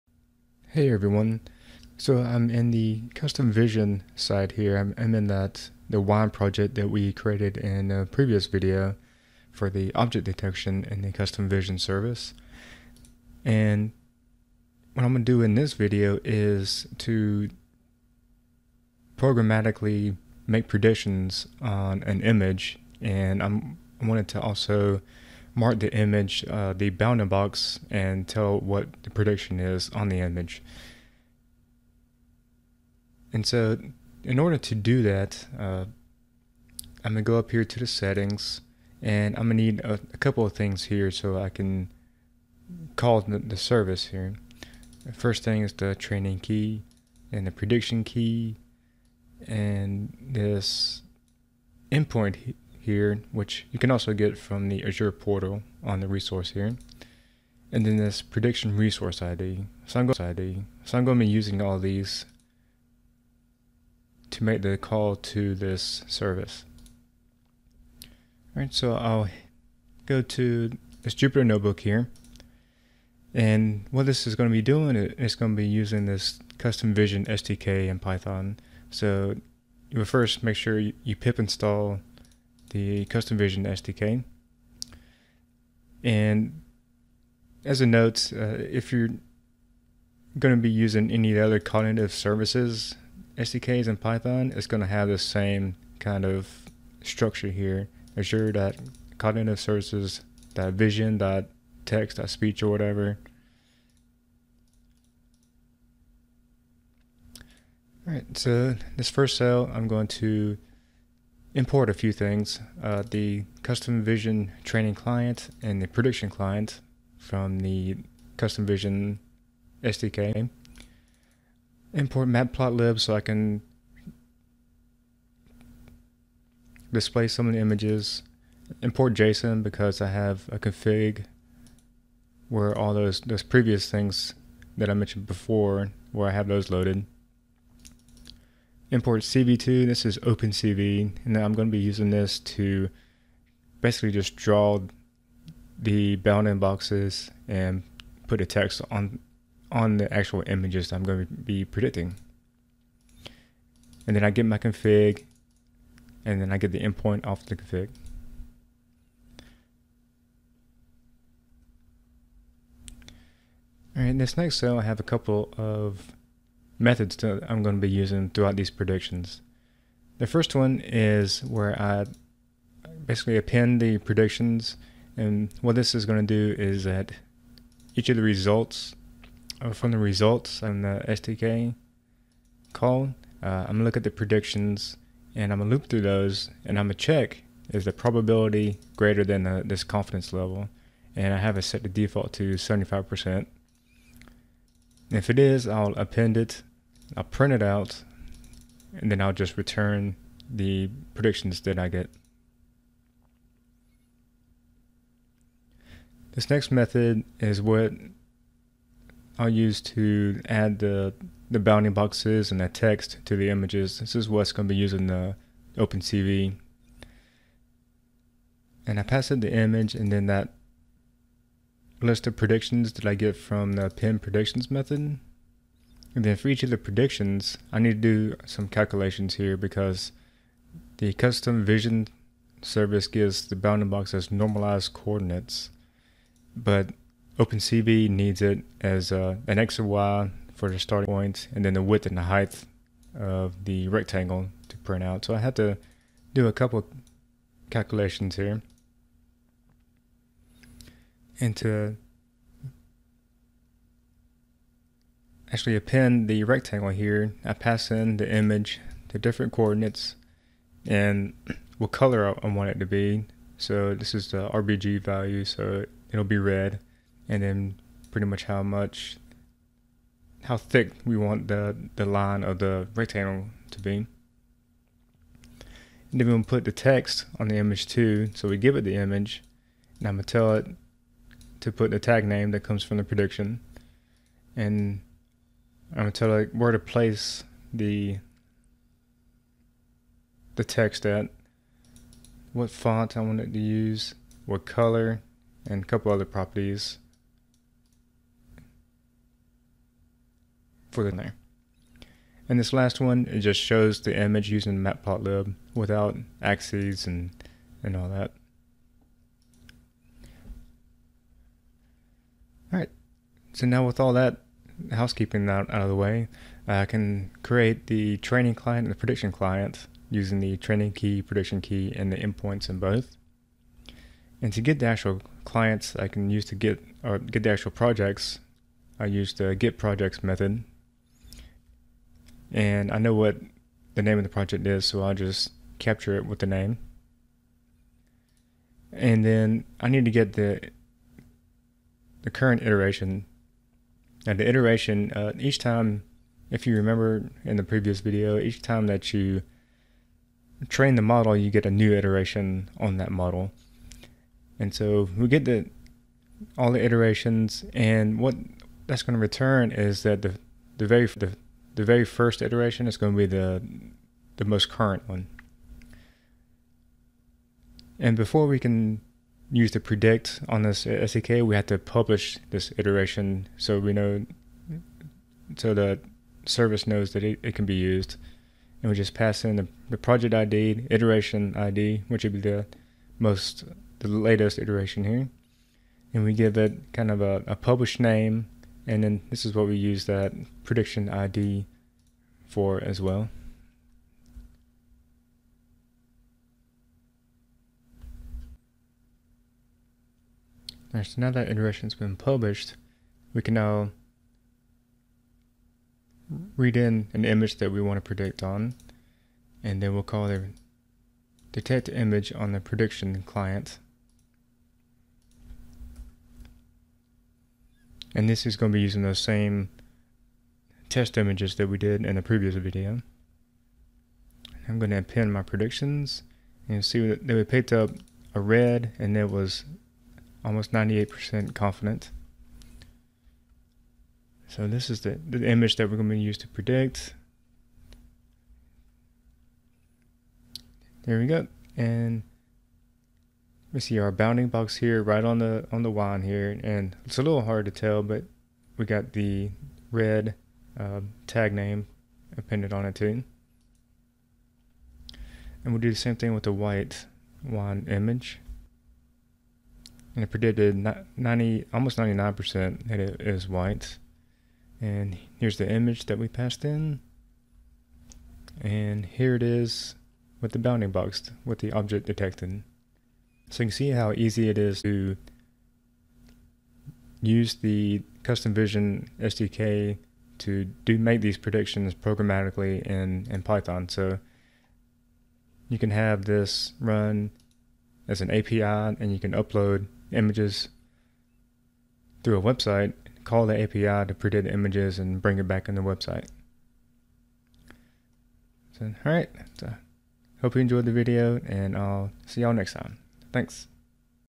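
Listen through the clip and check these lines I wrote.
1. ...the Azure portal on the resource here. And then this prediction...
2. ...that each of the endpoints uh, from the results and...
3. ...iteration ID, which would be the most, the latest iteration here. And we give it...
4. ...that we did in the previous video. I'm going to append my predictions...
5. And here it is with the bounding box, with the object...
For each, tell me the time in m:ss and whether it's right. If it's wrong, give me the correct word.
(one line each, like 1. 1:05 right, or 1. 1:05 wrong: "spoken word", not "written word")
1. 0:54 right
2. 2:56 wrong: "results", not "endpoints"
3. 6:20 right
4. 7:01 right
5. 7:48 right.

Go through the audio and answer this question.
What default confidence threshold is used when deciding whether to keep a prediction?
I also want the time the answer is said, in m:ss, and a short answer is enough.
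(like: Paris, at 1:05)
75%, at 3:12.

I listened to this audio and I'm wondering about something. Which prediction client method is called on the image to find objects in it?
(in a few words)
detect image.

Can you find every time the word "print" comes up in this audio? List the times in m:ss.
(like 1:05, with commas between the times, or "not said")
3:17, 4:04.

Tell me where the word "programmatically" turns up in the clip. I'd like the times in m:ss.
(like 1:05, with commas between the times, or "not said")
0:19, 8:01.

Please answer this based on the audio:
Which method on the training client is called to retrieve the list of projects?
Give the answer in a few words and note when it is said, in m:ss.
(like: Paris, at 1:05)
get projects, at 5:29.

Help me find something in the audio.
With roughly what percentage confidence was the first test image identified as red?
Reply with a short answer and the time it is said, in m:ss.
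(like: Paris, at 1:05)
98%, at 7:10.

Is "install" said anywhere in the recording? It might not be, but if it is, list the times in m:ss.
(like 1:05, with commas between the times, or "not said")
1:21.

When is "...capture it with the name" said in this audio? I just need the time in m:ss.
5:35.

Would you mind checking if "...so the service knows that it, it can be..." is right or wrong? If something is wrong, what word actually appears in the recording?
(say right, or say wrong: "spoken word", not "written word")
right.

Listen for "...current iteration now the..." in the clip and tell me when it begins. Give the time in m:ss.
5:42.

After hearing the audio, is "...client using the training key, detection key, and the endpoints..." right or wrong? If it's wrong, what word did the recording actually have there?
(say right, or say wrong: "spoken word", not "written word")
wrong: "prediction", not "detection".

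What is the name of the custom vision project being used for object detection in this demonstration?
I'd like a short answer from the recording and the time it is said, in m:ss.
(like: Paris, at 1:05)
wine project, at 0:05.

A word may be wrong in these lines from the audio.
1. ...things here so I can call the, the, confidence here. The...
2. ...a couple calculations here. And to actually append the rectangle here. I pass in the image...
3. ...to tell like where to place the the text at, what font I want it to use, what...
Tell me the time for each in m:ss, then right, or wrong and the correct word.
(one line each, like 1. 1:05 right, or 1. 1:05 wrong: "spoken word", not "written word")
1. 0:40 wrong: "service", not "confidence"
2. 4:06 right
3. 4:46 right.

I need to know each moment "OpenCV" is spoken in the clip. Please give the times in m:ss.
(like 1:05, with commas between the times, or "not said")
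2:20, 3:35, 3:57.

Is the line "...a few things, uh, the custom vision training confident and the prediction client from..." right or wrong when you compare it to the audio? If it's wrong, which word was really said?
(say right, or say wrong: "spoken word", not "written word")
wrong: "client", not "confident".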